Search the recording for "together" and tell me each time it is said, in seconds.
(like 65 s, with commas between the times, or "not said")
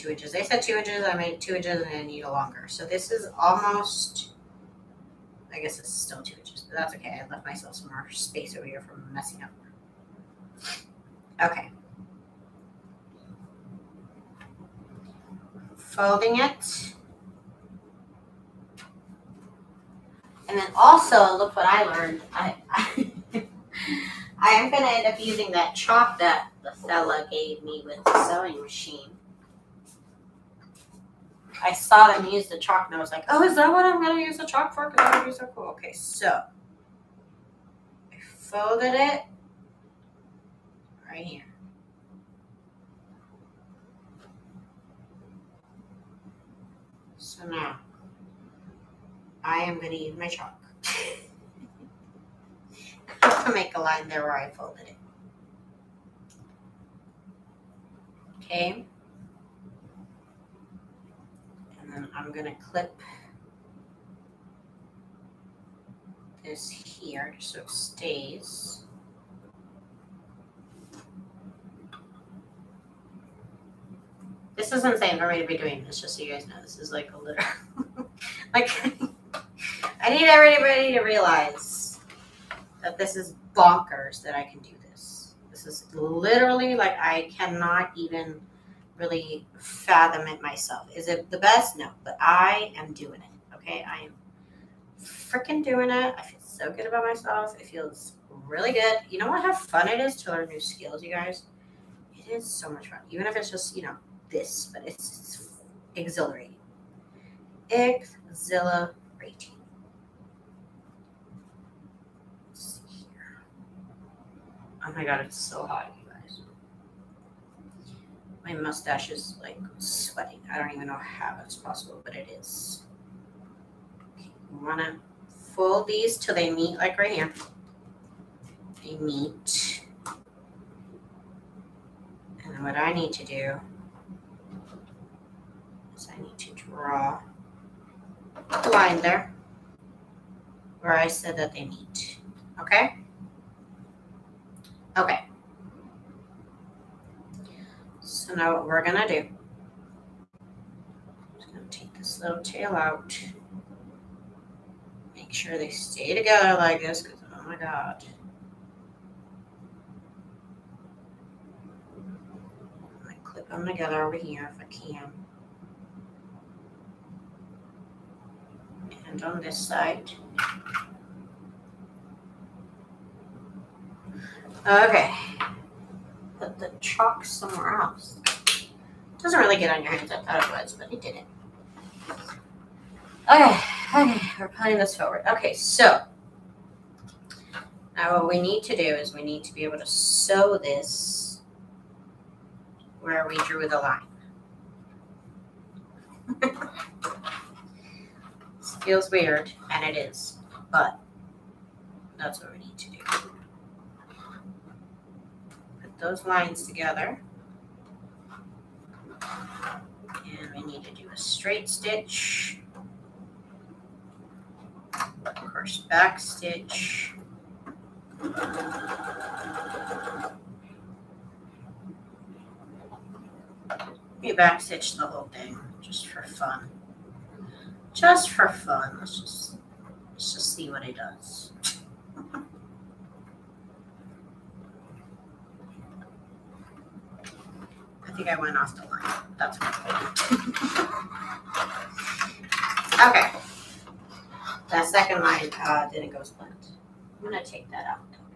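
156 s, 163 s, 206 s.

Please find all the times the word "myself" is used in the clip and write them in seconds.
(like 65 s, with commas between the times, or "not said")
7 s, 90 s, 97 s.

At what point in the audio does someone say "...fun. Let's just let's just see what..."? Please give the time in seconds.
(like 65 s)
228 s.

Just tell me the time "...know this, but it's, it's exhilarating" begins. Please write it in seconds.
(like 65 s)
103 s.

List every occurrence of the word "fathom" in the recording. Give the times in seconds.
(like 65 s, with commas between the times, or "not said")
89 s.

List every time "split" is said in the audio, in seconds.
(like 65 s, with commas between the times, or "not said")
246 s.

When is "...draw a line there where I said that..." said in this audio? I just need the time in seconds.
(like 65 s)
136 s.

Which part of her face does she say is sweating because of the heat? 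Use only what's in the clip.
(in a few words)
mustache.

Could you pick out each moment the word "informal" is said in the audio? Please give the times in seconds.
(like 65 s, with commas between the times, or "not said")
not said.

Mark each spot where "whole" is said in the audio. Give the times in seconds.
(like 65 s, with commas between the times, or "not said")
225 s.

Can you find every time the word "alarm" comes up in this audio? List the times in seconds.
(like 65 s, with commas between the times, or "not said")
not said.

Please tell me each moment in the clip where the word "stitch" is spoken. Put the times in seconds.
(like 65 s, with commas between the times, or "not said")
211 s, 216 s, 224 s.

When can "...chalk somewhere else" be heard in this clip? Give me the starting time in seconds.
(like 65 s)
176 s.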